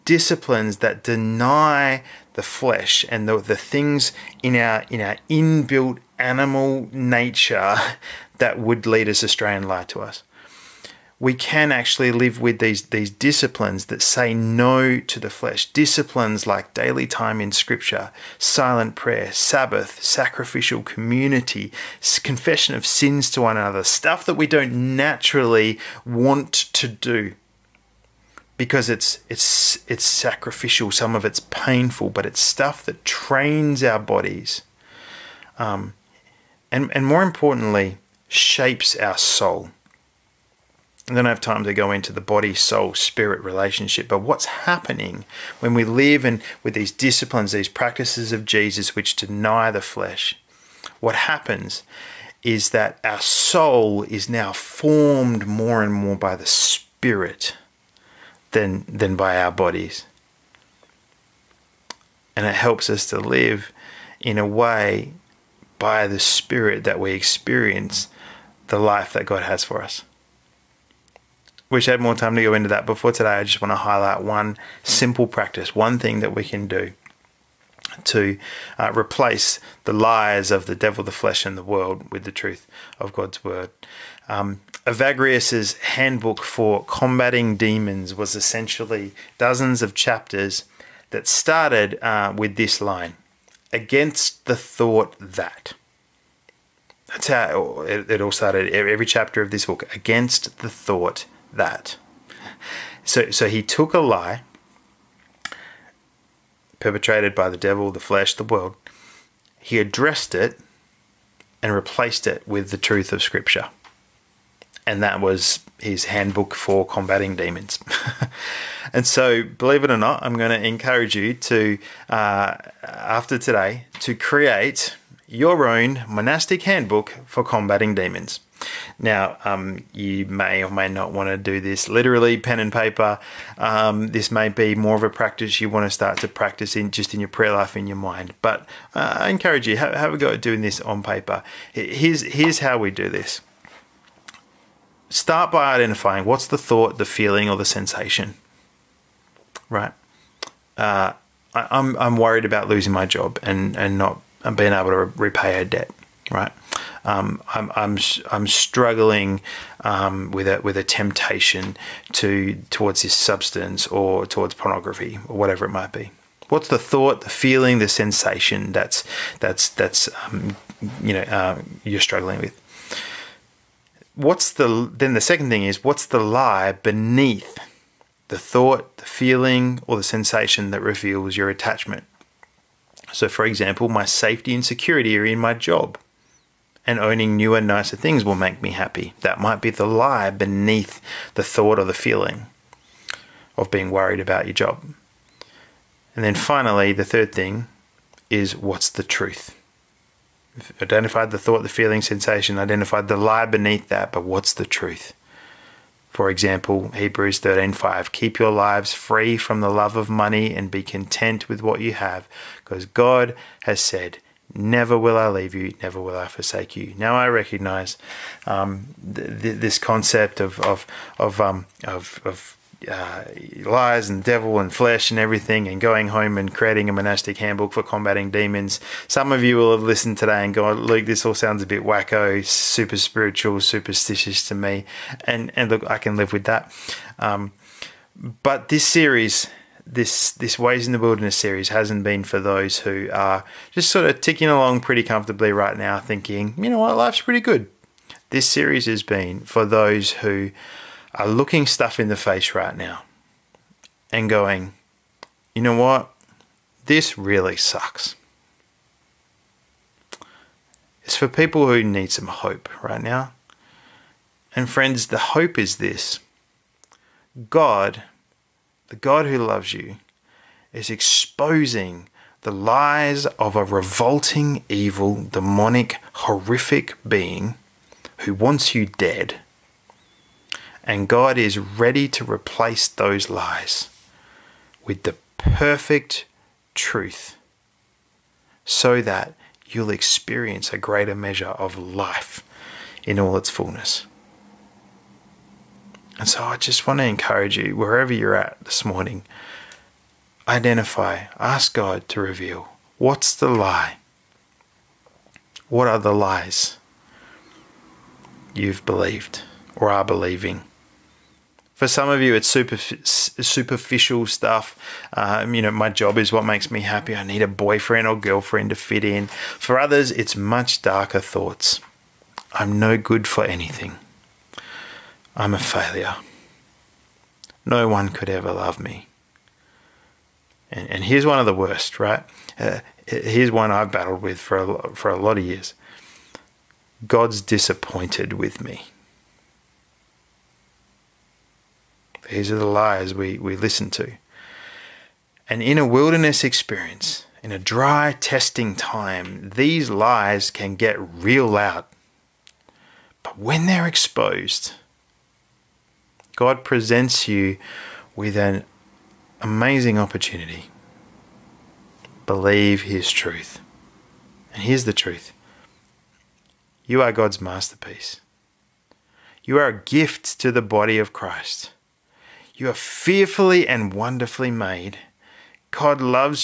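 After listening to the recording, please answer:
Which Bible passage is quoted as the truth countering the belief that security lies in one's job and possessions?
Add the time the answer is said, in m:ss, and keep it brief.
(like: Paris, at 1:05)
Hebrews 13:5, at 3:26.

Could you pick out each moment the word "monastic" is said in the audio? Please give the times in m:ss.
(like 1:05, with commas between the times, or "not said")
2:06, 3:46.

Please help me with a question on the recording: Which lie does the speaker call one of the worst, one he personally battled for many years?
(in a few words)
God's disappointed with me.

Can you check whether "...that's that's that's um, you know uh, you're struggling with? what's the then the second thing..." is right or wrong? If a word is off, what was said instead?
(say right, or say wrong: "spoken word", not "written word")
right.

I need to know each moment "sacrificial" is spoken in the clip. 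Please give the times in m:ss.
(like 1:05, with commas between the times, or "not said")
0:20, 0:30.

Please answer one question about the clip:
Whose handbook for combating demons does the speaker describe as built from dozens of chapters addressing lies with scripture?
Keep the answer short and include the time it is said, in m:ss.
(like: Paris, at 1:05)
Evagrius, at 1:24.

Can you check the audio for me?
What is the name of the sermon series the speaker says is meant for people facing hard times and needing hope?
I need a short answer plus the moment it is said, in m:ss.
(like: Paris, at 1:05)
Ways in the Wilderness, at 4:00.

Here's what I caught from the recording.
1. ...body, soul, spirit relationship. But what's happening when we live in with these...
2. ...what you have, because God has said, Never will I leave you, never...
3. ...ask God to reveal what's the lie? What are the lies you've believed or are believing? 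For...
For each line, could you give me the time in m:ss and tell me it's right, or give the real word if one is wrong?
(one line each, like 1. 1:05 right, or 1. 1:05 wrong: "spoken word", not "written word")
1. 0:42 right
2. 3:31 right
3. 5:01 right.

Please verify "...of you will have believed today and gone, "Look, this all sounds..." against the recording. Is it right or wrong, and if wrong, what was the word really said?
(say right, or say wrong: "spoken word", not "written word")
wrong: "listened", not "believed".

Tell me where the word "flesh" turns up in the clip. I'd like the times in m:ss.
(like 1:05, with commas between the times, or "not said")
0:02, 0:15, 0:49, 1:21, 1:47, 3:44.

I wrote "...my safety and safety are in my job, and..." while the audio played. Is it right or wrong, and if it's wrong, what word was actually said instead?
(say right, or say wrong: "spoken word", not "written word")
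wrong: "security", not "safety".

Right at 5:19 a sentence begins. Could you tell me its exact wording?
For others, it's much darker thoughts.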